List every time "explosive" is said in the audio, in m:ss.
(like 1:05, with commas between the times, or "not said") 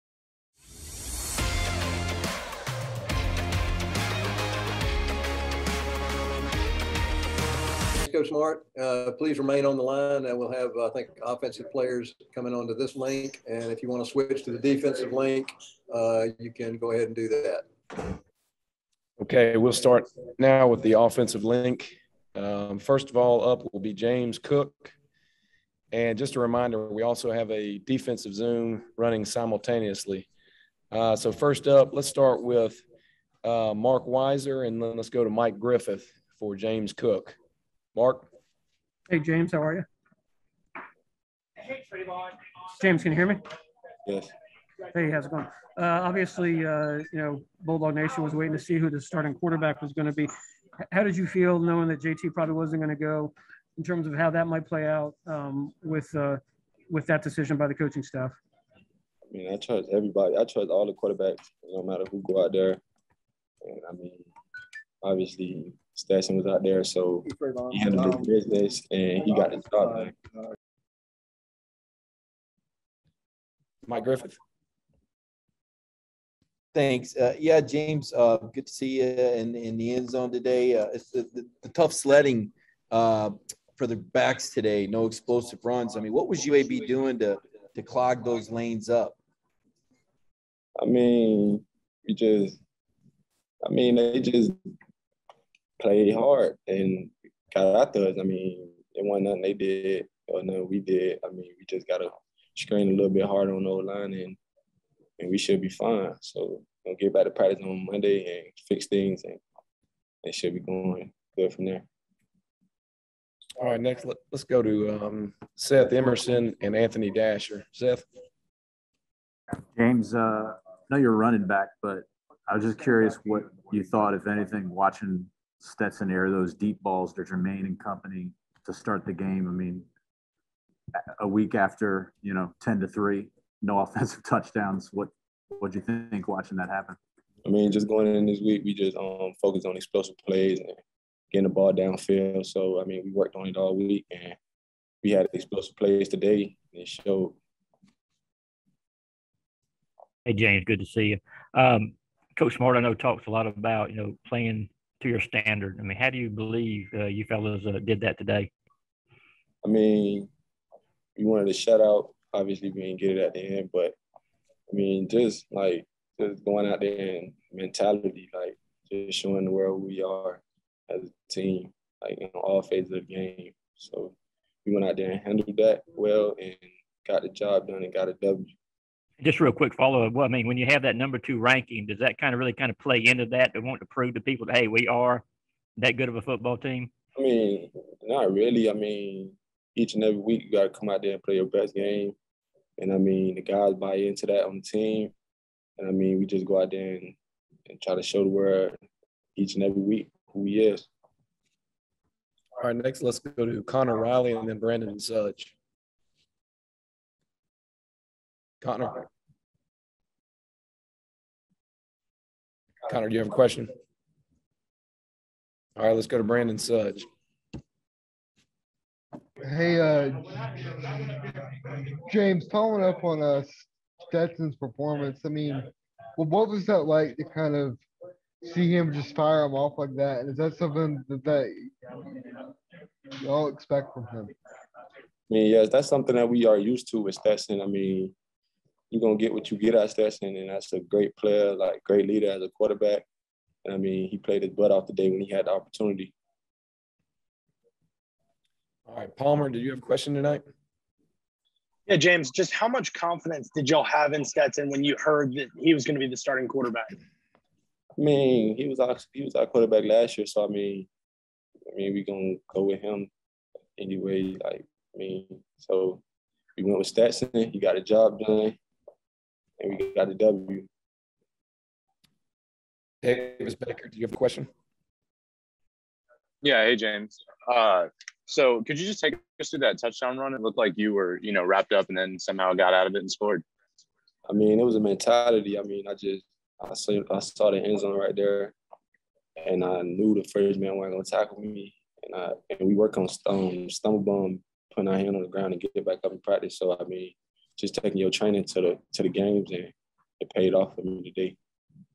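1:25, 2:19, 2:25.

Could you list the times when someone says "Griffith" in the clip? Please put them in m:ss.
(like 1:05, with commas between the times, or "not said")
0:35, 1:14.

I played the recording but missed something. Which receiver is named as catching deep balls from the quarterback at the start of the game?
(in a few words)
Jermaine.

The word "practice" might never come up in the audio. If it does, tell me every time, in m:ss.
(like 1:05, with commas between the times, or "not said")
1:47, 4:56.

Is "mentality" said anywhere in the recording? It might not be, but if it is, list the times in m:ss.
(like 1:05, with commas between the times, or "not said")
2:47, 4:44.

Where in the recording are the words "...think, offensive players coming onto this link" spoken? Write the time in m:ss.
0:10.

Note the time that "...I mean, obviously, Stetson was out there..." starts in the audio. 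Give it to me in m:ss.
1:03.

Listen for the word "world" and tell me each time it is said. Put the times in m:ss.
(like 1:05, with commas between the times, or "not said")
2:49, 3:18.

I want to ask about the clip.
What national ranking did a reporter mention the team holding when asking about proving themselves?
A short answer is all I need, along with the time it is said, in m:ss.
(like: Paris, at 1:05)
Number 2, at 3:00.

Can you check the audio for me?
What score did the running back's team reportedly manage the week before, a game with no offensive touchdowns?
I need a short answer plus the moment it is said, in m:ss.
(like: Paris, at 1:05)
10 to 3, at 2:12.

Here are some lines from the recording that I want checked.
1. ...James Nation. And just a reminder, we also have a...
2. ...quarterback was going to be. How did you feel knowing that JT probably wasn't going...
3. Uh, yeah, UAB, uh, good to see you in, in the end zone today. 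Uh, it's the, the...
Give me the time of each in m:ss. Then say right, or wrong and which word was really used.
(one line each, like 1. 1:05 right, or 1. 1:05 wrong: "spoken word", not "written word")
1. 0:23 wrong: "Cook", not "Nation"
2. 0:49 right
3. 1:17 wrong: "James", not "UAB".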